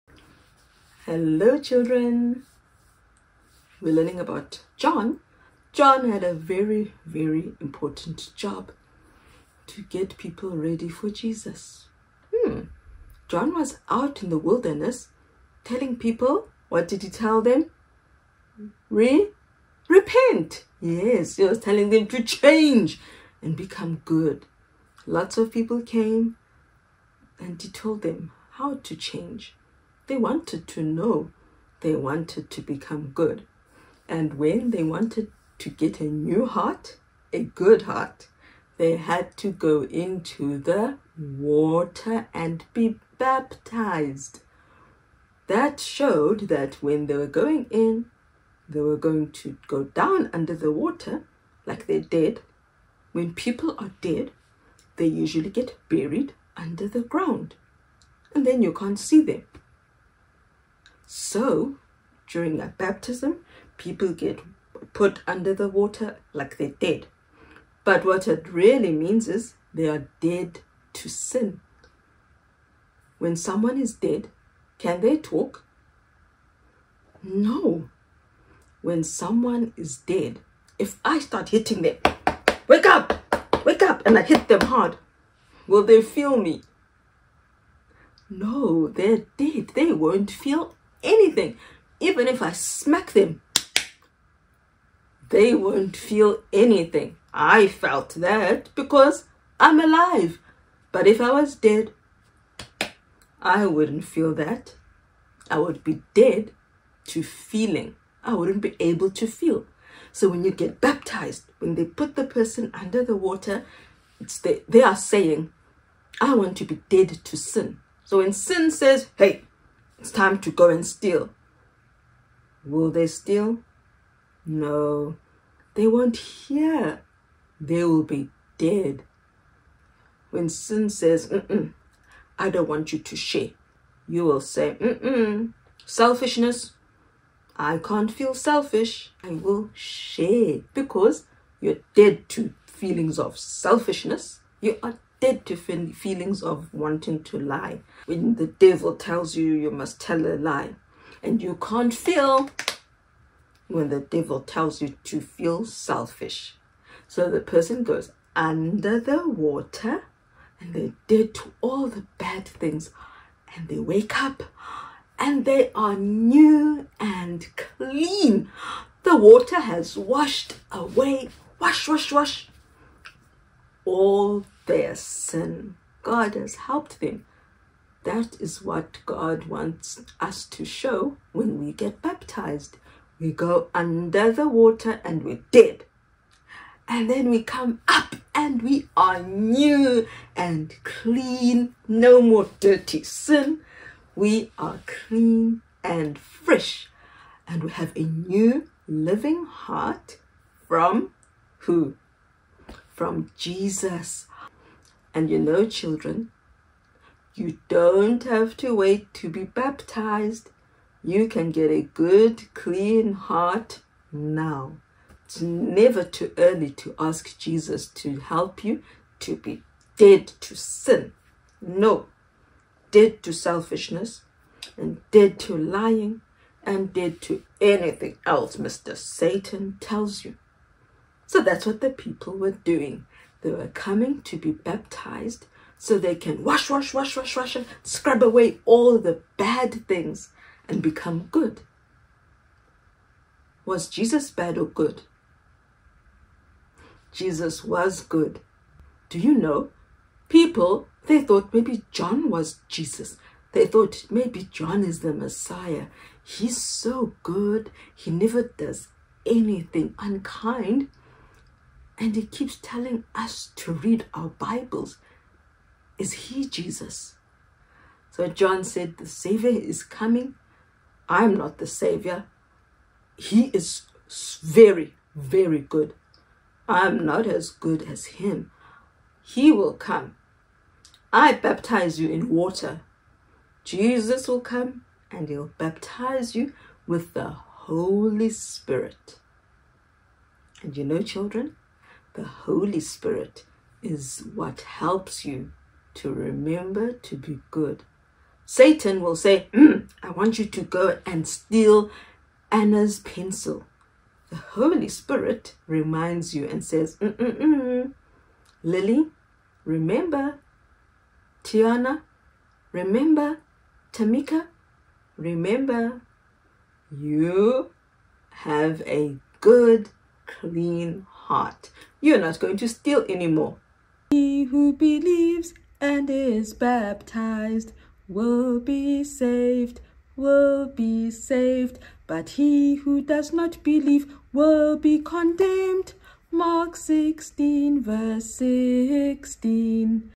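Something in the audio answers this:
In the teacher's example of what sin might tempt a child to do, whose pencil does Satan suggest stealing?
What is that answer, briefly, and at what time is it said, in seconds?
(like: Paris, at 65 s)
Anna, at 302 s.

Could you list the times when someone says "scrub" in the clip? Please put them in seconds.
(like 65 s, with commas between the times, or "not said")
237 s.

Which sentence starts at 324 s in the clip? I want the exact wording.
He who believes and is baptized will be saved, will be saved.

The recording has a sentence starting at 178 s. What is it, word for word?
That is what God wants us to show when we get baptized.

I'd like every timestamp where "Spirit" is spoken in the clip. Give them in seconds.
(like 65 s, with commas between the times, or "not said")
288 s, 292 s, 304 s.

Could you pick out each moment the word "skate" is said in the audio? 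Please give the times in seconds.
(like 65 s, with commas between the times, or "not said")
not said.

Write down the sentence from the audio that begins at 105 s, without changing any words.
I would be dead to feeling.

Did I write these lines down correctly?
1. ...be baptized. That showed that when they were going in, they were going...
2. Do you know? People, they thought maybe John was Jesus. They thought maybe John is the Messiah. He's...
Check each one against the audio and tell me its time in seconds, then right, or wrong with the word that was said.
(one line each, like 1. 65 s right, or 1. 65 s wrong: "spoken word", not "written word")
1. 42 s right
2. 249 s right.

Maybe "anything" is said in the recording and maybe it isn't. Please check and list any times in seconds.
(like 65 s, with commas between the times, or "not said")
91 s, 96 s, 227 s, 259 s.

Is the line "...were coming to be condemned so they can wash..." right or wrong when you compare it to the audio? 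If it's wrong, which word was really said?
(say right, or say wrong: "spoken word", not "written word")
wrong: "baptized", not "condemned".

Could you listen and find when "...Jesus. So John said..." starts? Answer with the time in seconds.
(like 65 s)
266 s.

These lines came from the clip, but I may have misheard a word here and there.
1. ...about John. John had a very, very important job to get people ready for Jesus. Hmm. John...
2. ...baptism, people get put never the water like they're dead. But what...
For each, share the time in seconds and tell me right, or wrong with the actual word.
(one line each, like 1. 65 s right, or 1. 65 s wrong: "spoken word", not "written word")
1. 4 s right
2. 62 s wrong: "under", not "never".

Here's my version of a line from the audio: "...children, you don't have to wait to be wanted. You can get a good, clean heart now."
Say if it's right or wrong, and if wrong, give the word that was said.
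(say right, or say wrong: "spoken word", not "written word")
wrong: "baptized", not "wanted".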